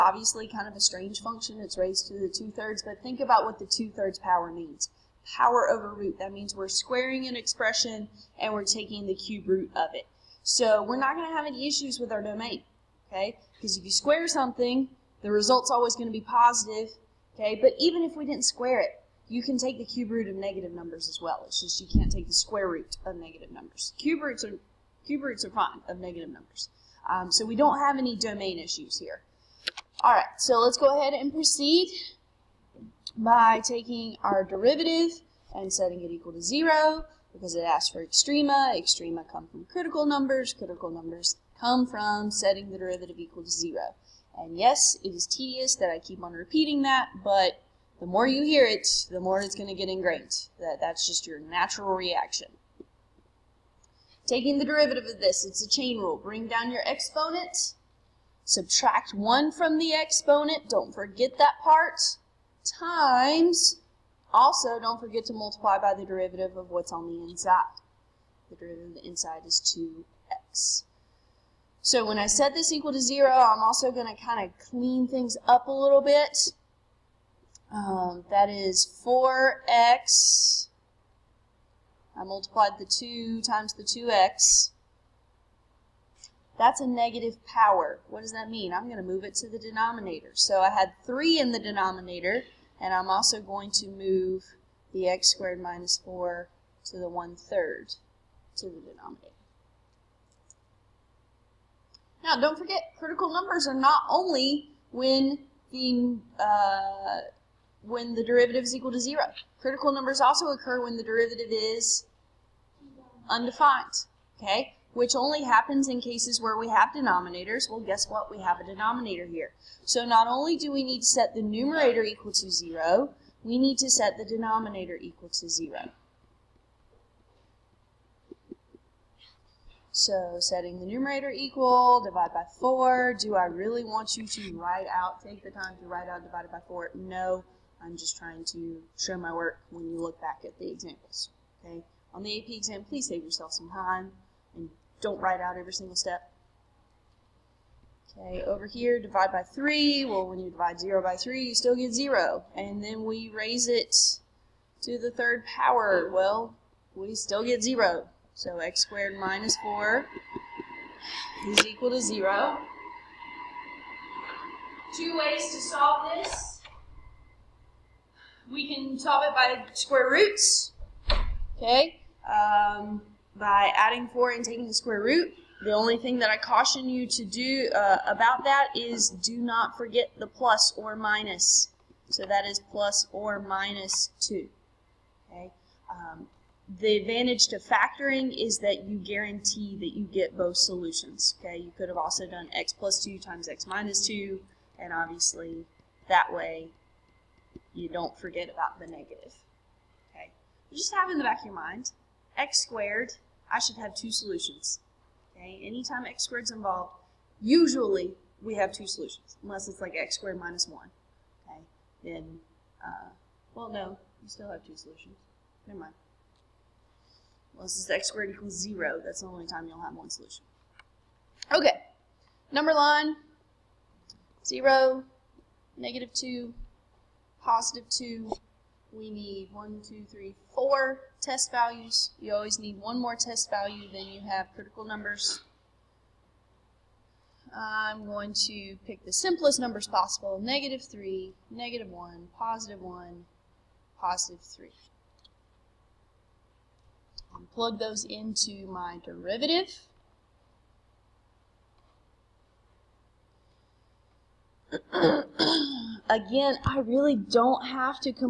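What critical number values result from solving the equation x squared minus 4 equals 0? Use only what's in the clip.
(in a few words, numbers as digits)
plus or minus 2.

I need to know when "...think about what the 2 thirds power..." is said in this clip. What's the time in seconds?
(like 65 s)
3 s.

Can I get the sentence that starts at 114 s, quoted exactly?
Okay, which only happens in cases where we have denominators.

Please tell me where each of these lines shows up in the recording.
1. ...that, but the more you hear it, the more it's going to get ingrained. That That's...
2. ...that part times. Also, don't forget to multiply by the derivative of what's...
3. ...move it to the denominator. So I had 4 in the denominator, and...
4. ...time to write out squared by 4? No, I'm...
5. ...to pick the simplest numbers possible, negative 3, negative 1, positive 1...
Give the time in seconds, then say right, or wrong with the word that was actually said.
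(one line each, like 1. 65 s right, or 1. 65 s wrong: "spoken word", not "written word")
1. 46 s right
2. 61 s right
3. 89 s wrong: "3", not "4"
4. 135 s wrong: "divided", not "squared"
5. 238 s right.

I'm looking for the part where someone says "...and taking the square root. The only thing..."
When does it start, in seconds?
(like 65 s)
174 s.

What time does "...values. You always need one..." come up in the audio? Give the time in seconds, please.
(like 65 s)
231 s.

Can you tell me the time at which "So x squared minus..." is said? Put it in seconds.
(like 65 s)
158 s.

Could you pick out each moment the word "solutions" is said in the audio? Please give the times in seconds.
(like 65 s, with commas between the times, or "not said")
190 s, 204 s, 208 s, 214 s, 220 s.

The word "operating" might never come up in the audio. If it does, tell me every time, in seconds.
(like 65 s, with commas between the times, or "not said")
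not said.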